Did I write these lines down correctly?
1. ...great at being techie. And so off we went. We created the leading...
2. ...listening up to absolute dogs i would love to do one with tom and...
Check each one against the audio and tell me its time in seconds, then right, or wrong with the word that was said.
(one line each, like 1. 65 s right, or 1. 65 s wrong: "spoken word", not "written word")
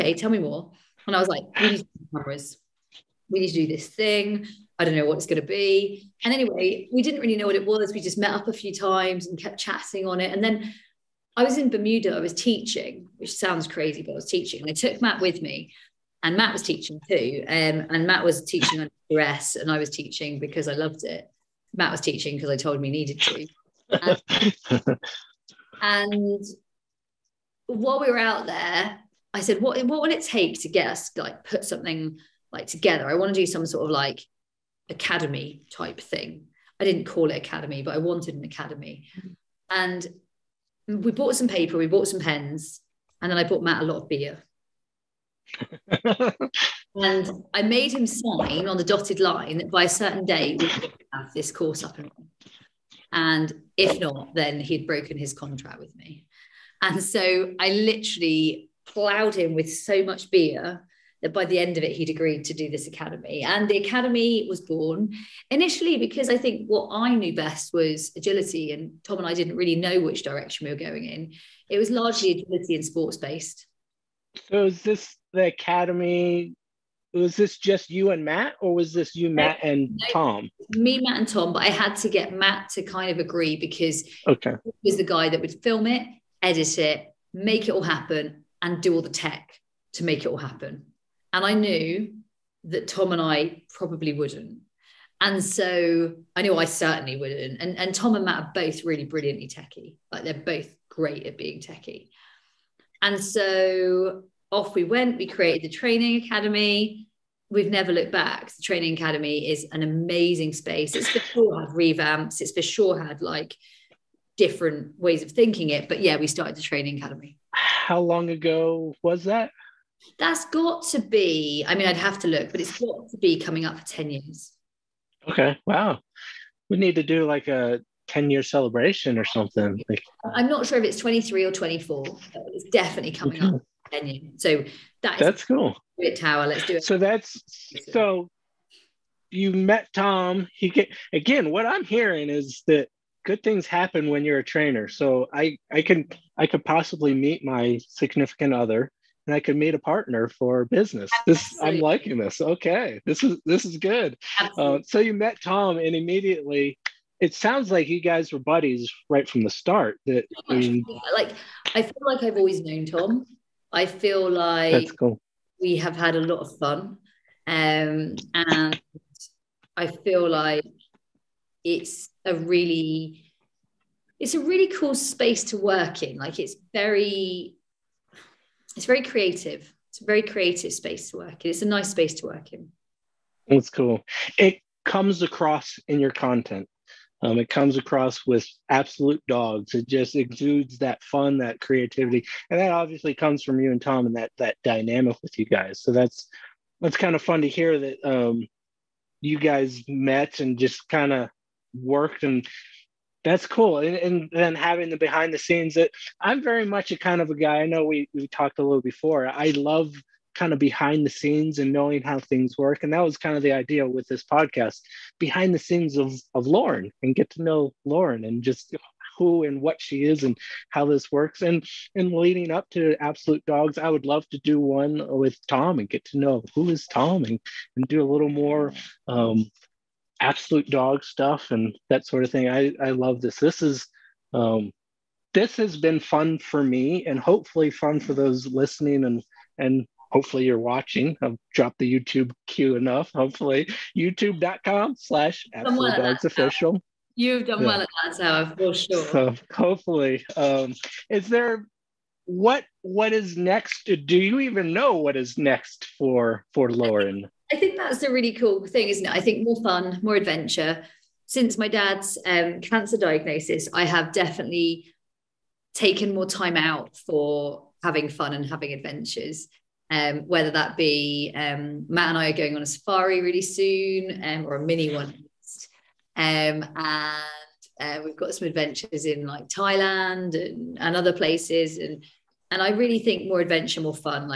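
1. 100 s wrong: "training", not "leading"
2. 222 s wrong: "leading", not "listening".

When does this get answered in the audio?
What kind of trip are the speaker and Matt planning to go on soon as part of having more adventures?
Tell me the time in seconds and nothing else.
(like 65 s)
272 s.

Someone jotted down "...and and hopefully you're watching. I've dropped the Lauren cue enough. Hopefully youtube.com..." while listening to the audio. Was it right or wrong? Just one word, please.
wrong.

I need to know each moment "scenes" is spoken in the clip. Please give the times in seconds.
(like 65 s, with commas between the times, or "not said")
205 s, 211 s, 215 s.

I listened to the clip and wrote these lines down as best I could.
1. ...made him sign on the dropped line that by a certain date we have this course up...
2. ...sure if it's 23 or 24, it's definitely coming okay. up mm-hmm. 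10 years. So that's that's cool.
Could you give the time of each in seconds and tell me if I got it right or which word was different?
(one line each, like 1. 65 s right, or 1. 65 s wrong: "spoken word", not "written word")
1. 47 s wrong: "dotted", not "dropped"
2. 130 s right.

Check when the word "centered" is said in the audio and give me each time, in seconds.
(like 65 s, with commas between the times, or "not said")
not said.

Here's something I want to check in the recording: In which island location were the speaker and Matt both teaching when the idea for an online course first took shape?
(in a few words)
Bermuda.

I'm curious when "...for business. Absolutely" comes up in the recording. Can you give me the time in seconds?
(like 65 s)
150 s.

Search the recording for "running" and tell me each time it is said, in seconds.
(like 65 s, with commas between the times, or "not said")
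52 s.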